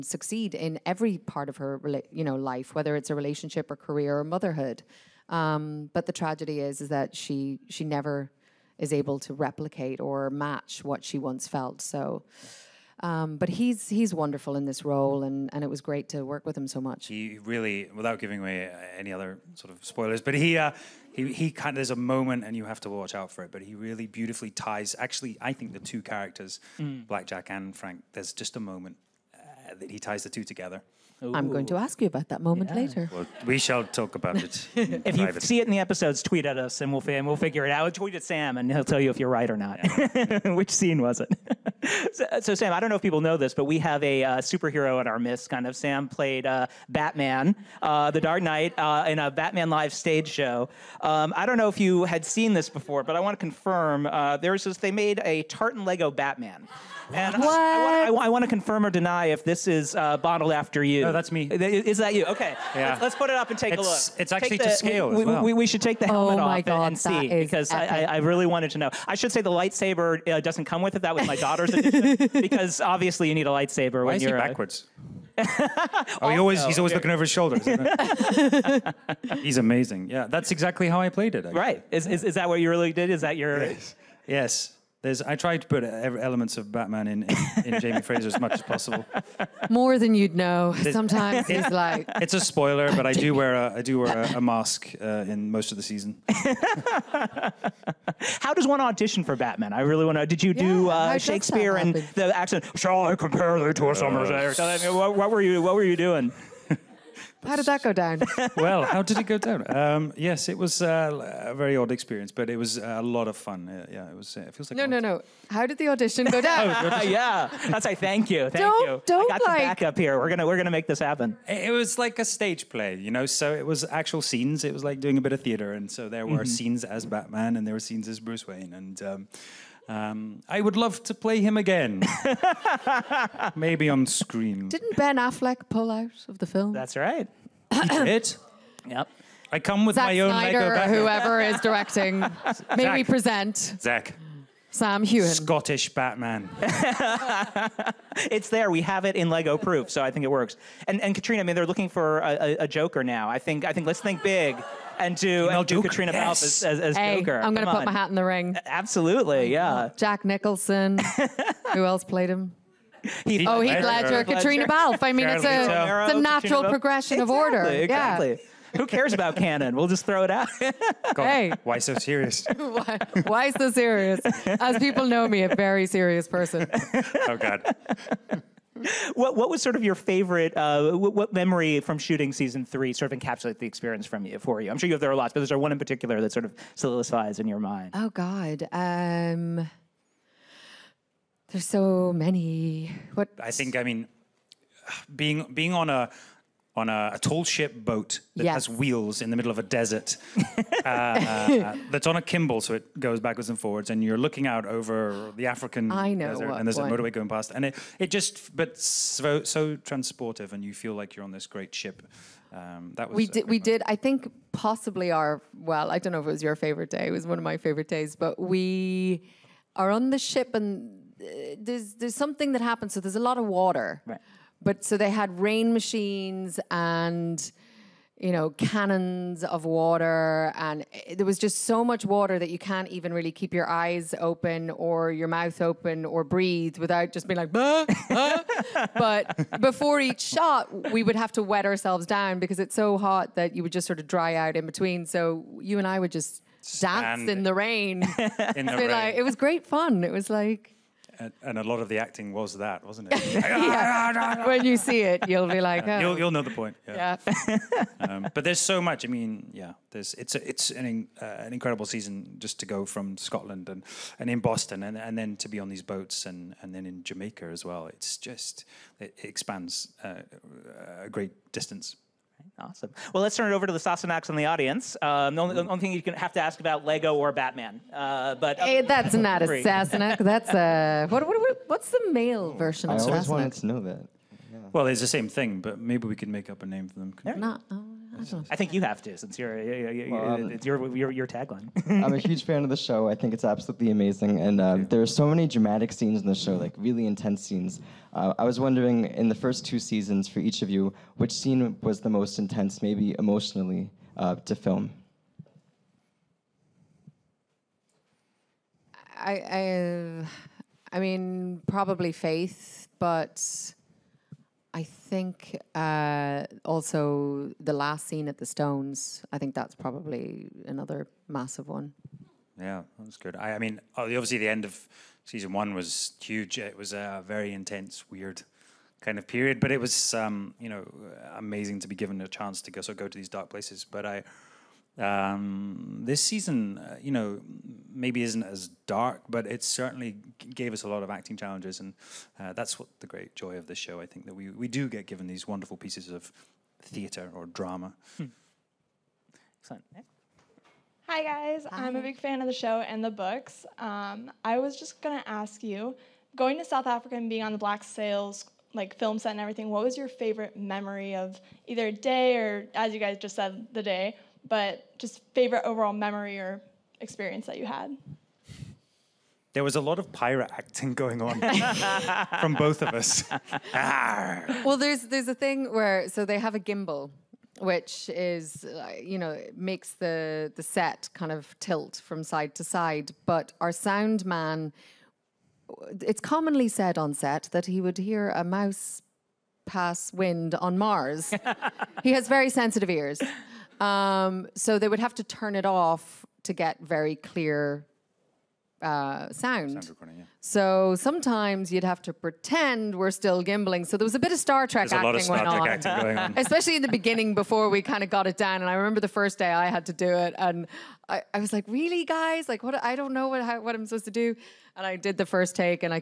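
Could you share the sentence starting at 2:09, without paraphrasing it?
Um, um, I would love to play him again.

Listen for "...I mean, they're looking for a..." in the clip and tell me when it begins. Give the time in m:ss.
2:31.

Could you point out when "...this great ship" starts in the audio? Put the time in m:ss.
3:31.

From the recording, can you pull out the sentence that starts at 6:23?
But our sound man, it's commonly said on set that he would hear a mouse pass wind on Mars.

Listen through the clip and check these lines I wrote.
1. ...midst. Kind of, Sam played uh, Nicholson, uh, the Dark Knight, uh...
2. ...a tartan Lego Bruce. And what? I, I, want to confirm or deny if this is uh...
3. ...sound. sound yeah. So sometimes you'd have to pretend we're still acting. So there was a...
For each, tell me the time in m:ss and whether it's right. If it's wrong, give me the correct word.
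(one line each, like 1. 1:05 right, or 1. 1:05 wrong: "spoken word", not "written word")
1. 0:45 wrong: "Batman", not "Nicholson"
2. 0:55 wrong: "Batman", not "Bruce"
3. 6:39 wrong: "gimbling", not "acting".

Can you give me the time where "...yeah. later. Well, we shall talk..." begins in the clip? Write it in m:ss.
0:32.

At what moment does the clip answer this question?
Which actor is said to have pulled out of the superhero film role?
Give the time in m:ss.
2:14.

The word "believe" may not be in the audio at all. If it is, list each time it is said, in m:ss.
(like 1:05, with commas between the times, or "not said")
not said.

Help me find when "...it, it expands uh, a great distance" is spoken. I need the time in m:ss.
4:28.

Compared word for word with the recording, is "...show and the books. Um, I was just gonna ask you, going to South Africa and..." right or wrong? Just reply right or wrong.
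right.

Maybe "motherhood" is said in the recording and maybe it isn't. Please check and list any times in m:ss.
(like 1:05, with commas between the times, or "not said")
0:04.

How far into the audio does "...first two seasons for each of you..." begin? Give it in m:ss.
4:59.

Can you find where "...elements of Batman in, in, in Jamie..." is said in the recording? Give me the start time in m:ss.
1:25.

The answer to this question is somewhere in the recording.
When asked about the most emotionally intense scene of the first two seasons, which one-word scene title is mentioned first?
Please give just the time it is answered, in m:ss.
5:12.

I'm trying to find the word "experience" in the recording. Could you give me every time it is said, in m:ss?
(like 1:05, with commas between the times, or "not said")
1:51, 3:03, 6:06.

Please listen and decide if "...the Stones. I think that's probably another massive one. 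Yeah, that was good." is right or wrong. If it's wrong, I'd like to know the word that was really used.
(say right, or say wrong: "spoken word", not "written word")
right.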